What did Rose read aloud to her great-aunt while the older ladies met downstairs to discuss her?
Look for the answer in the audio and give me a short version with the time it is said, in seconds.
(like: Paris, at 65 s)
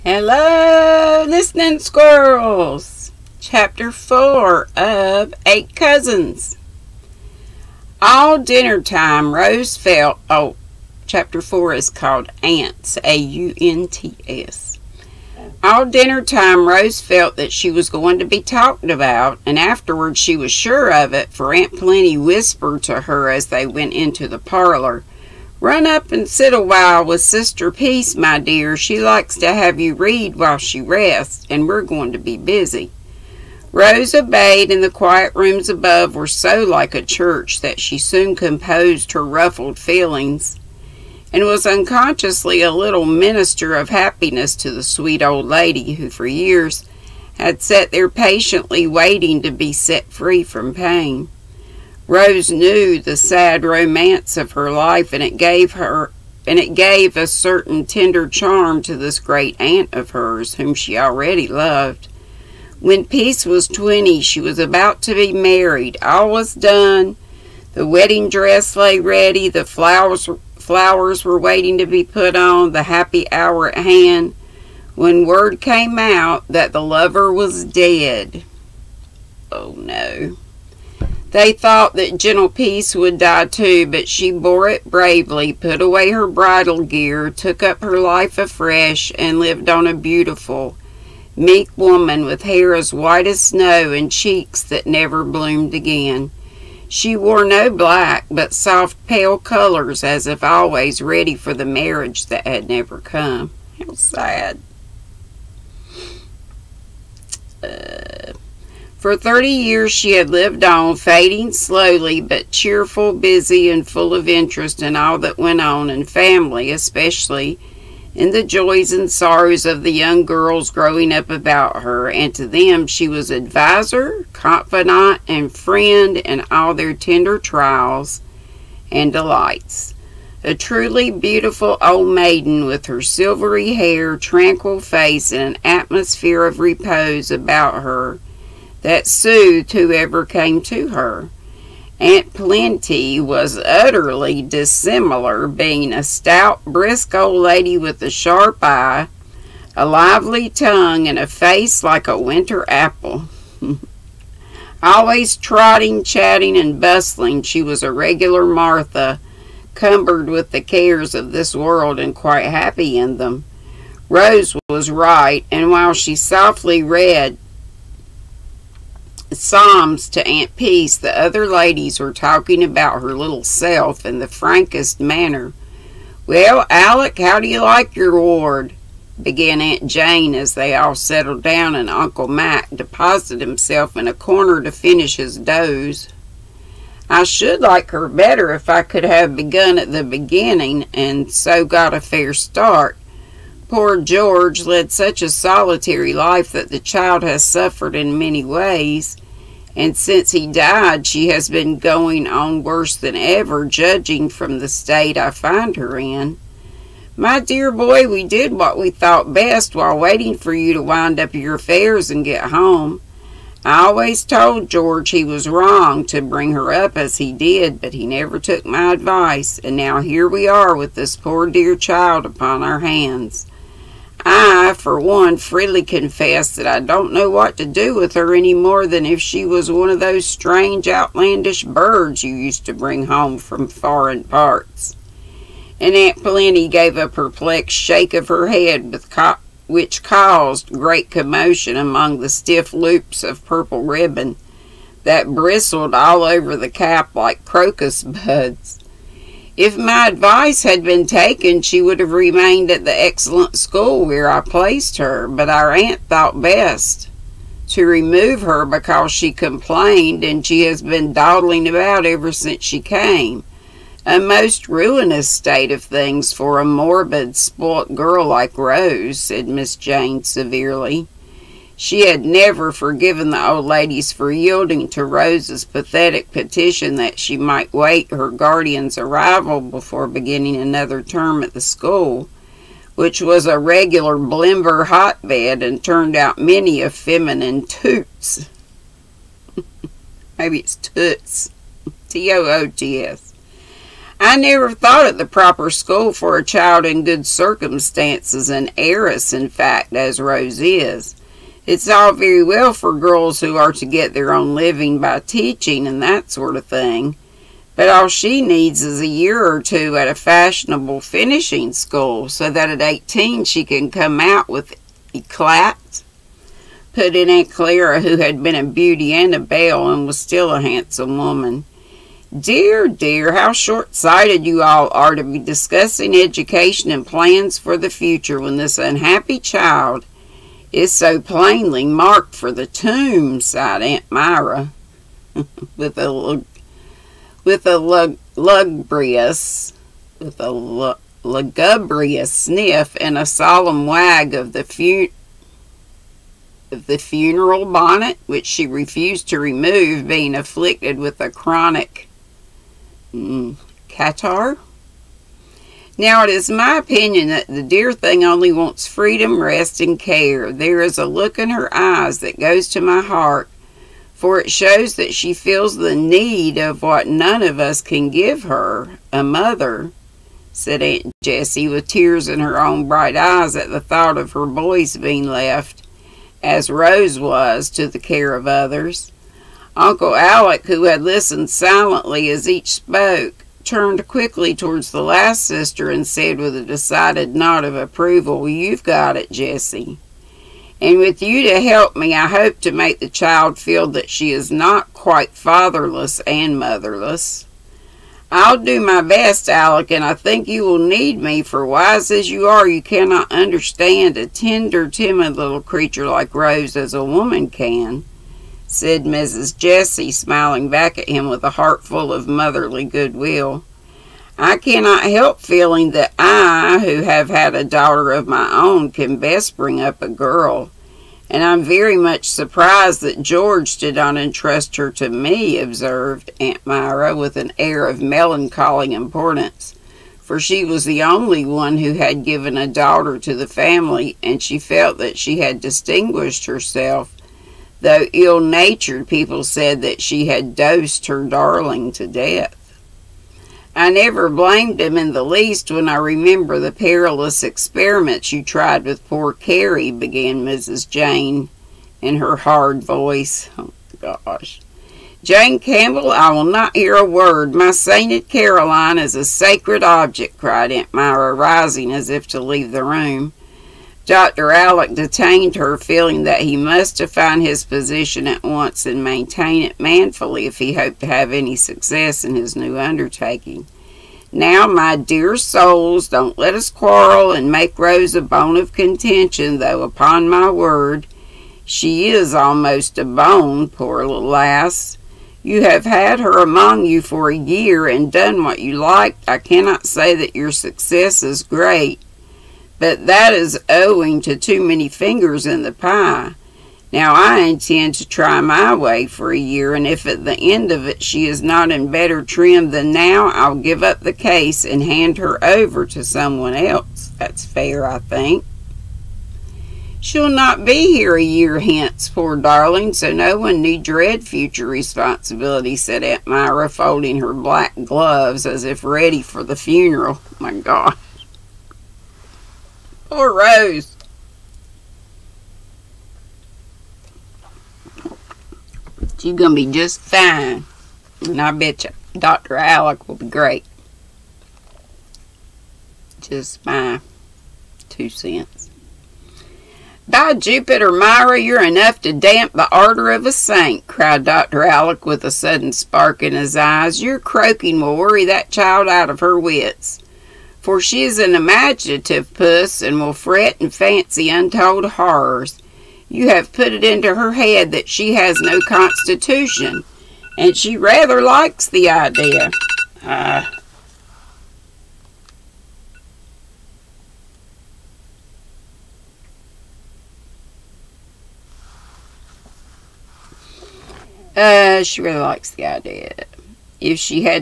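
Psalms, at 169 s.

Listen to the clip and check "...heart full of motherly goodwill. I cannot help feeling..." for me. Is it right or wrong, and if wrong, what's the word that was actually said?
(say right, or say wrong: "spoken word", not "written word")
right.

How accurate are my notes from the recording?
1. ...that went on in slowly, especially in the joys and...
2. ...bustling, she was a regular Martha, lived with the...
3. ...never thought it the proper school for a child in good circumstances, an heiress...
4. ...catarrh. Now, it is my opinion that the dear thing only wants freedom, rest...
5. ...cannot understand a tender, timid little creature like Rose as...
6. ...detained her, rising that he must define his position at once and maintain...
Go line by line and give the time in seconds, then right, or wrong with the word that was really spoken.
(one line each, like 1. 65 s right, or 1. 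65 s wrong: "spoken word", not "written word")
1. 115 s wrong: "family", not "slowly"
2. 156 s wrong: "cumbered", not "lived"
3. 294 s right
4. 353 s right
5. 402 s right
6. 464 s wrong: "feeling", not "rising".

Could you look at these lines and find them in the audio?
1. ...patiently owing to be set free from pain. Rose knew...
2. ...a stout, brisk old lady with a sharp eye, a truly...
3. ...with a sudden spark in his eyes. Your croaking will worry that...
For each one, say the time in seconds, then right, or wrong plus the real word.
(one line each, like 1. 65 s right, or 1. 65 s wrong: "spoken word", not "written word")
1. 48 s wrong: "waiting", not "owing"
2. 145 s wrong: "lively", not "truly"
3. 545 s right.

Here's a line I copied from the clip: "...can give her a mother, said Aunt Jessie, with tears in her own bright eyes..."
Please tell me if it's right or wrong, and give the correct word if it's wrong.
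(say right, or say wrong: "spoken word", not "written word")
right.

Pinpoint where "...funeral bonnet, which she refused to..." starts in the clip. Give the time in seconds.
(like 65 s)
346 s.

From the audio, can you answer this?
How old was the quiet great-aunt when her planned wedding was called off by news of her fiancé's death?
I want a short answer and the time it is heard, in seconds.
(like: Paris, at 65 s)
20, at 63 s.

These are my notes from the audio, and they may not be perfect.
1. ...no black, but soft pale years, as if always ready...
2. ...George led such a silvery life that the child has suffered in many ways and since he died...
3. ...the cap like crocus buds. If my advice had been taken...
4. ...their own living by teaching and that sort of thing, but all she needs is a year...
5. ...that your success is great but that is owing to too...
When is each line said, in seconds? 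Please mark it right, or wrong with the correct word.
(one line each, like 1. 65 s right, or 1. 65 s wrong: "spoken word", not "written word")
1. 97 s wrong: "colors", not "years"
2. 194 s wrong: "solitary", not "silvery"
3. 246 s right
4. 304 s right
5. 490 s right.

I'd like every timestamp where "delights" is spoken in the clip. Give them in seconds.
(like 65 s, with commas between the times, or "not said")
129 s.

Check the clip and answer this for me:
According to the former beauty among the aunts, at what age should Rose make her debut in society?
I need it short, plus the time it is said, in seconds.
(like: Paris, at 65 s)
18, at 312 s.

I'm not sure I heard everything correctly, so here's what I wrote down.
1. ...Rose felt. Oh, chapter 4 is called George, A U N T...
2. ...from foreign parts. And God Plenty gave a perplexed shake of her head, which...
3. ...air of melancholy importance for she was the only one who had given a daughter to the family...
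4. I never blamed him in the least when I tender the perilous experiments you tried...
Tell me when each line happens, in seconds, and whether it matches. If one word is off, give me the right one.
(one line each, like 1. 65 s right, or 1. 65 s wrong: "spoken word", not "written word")
1. 9 s wrong: "Ants", not "George"
2. 233 s wrong: "Aunt", not "God"
3. 427 s right
4. 443 s wrong: "remember", not "tender".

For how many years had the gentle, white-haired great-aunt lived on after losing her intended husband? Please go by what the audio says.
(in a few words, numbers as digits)
thirty.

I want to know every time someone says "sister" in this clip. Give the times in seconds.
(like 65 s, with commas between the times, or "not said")
27 s, 385 s.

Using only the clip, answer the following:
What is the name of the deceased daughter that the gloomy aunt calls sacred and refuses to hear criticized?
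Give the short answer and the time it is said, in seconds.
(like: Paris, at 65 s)
Caroline, at 458 s.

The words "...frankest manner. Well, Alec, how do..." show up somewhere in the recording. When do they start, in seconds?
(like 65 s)
174 s.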